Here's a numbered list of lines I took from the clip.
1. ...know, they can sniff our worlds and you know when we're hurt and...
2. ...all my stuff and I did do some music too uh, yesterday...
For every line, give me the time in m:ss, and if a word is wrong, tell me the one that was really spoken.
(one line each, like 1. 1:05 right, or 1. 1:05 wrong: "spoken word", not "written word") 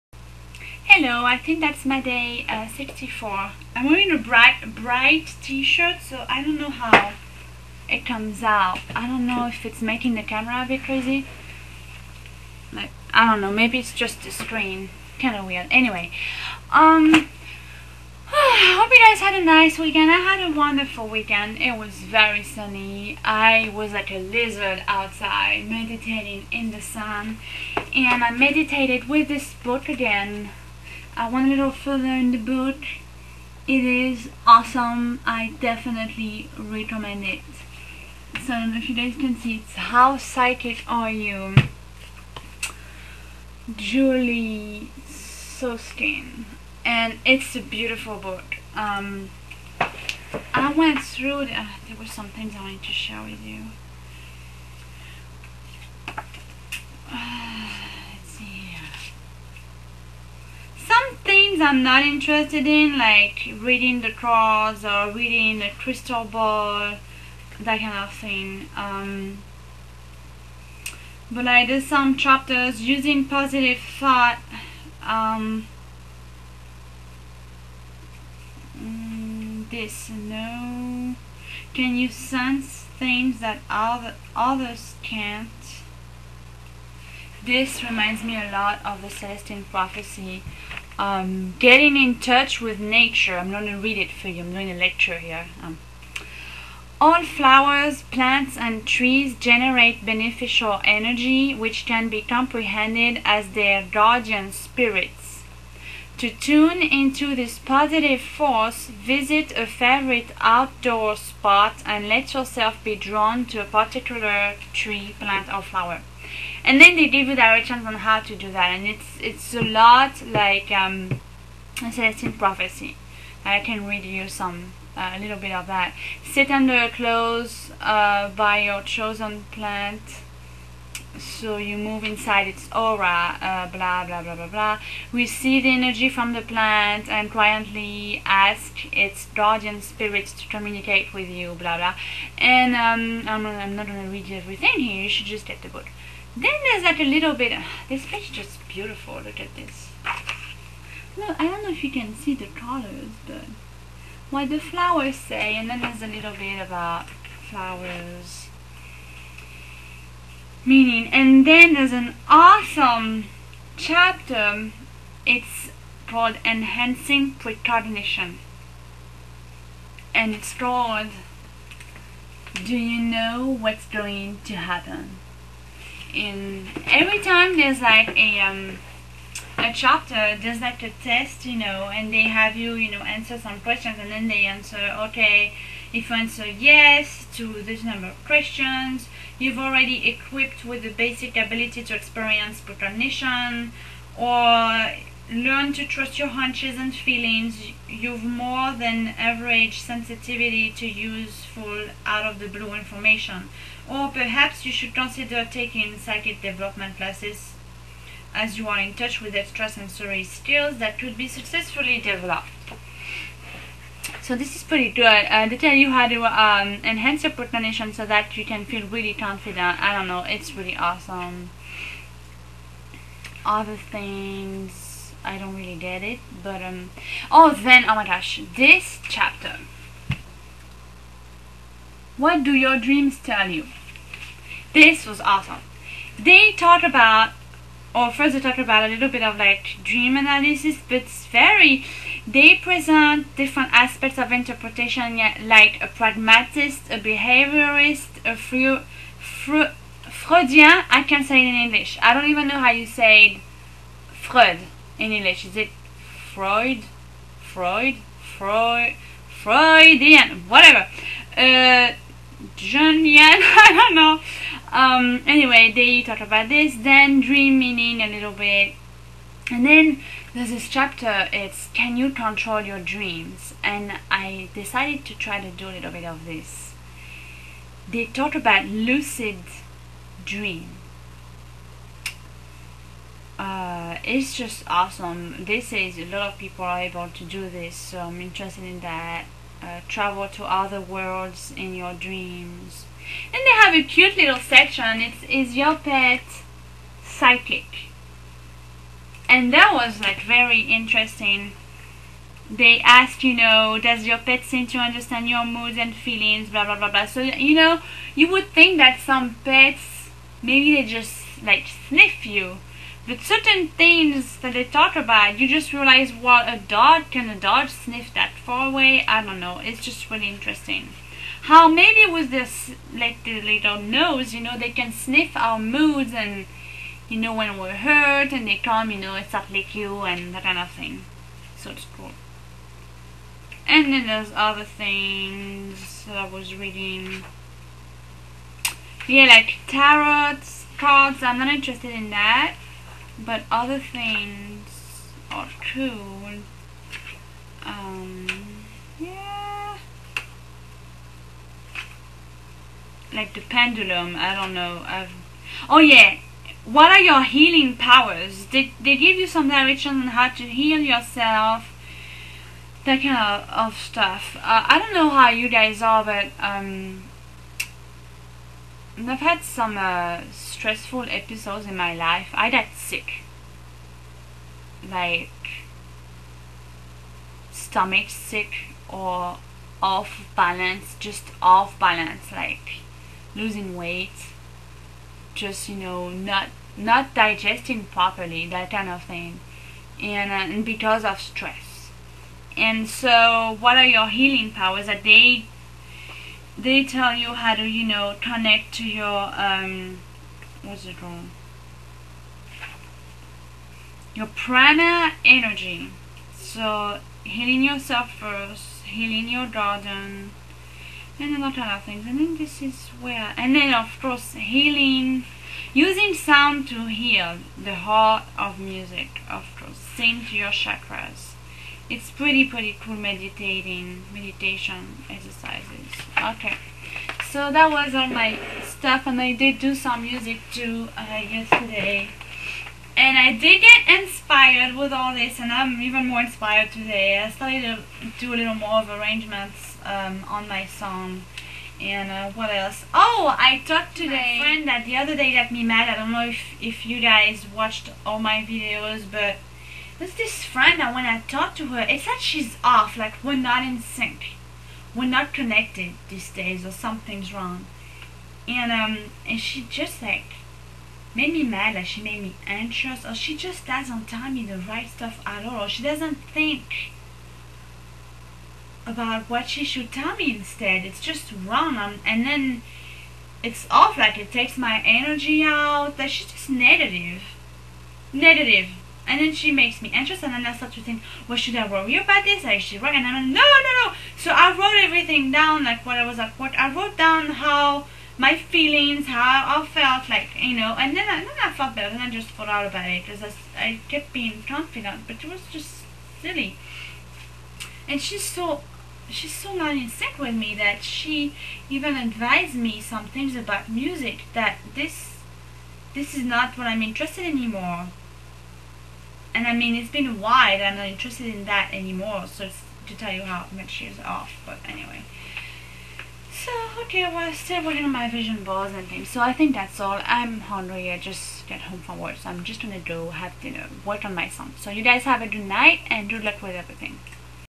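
1. 5:24 wrong: "moods", not "worlds"
2. 7:07 right.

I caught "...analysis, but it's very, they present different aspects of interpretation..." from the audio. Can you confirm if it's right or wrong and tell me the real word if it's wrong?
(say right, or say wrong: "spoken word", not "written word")
right.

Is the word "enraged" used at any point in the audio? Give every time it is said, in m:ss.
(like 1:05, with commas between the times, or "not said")
not said.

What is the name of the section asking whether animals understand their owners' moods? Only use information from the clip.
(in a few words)
Is your pet psychic.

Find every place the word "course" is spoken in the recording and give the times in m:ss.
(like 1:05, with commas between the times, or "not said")
6:53, 6:59.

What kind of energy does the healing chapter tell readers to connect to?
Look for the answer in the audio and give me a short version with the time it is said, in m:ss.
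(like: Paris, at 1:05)
Prana energy, at 6:44.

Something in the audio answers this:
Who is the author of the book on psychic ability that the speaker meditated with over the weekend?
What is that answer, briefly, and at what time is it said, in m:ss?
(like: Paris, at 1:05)
Julie Soskin, at 0:43.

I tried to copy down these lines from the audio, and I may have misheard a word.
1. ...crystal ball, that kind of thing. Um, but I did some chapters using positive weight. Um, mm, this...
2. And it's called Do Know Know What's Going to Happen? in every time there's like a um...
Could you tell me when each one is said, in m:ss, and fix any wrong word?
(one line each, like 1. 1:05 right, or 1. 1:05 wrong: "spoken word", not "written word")
1. 1:05 wrong: "thought", not "weight"
2. 2:50 wrong: "You", not "Know".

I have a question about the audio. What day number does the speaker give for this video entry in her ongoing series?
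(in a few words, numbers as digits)
64.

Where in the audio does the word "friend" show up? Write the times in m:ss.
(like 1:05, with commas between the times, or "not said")
7:24, 7:30.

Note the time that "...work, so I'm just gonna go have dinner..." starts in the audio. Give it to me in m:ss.
8:41.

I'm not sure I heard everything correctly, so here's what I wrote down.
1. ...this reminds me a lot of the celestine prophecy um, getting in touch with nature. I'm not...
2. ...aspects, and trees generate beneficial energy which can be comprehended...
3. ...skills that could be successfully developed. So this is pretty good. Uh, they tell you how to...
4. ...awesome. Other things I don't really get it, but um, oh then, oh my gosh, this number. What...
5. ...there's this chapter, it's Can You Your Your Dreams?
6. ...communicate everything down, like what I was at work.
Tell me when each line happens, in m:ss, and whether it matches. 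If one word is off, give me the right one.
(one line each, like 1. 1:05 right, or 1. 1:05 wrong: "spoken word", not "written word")
1. 1:27 right
2. 1:38 wrong: "plants", not "aspects"
3. 3:30 right
4. 3:40 wrong: "chapter", not "number"
5. 4:30 wrong: "Control", not "Your"
6. 8:04 wrong: "wrote", not "communicate".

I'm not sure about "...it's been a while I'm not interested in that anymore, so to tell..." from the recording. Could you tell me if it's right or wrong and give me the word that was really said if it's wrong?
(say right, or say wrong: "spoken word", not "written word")
right.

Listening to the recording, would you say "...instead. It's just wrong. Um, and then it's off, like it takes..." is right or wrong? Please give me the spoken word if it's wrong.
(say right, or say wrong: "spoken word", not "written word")
right.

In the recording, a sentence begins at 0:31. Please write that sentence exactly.
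I went a little further in the book.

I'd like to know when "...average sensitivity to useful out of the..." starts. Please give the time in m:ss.
3:19.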